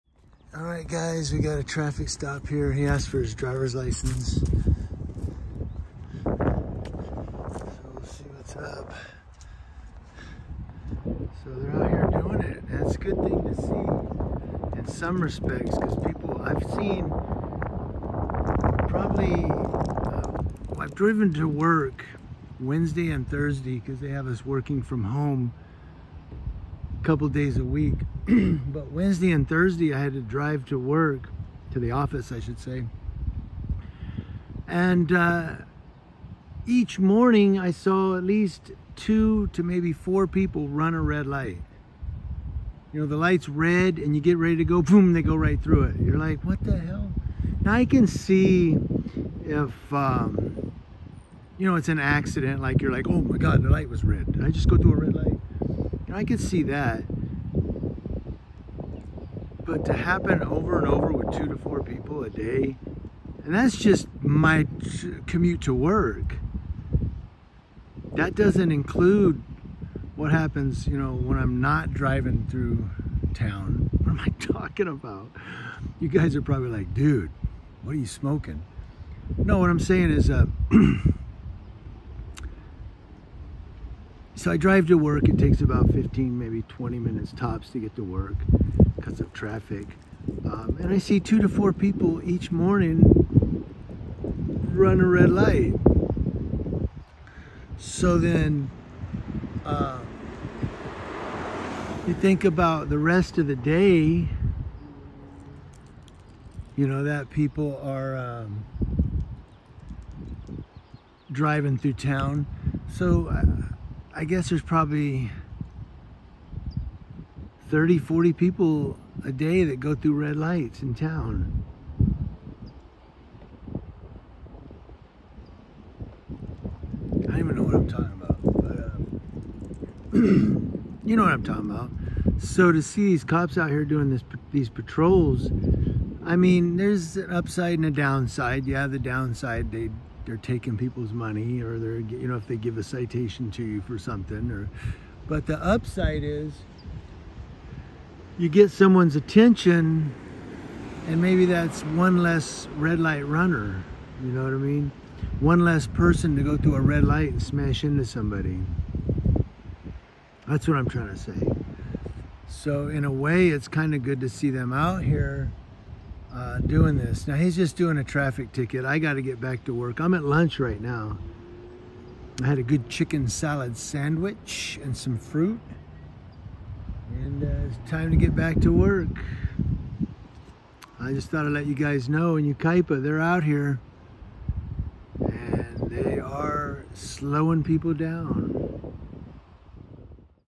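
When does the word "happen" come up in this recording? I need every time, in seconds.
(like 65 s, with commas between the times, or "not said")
59 s, 70 s.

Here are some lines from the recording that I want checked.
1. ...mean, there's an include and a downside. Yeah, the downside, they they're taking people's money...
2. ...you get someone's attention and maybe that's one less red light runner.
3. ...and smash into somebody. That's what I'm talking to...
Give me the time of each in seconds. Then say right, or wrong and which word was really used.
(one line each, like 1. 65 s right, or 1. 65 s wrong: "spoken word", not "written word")
1. 136 s wrong: "upside", not "include"
2. 148 s right
3. 157 s wrong: "trying", not "talking".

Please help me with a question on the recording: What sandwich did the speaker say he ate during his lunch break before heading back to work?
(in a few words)
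Chicken salad sandwich.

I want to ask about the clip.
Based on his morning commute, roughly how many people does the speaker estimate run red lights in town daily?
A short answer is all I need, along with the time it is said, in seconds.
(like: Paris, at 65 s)
30, 40, at 117 s.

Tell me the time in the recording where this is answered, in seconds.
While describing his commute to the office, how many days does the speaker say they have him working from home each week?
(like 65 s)
27 s.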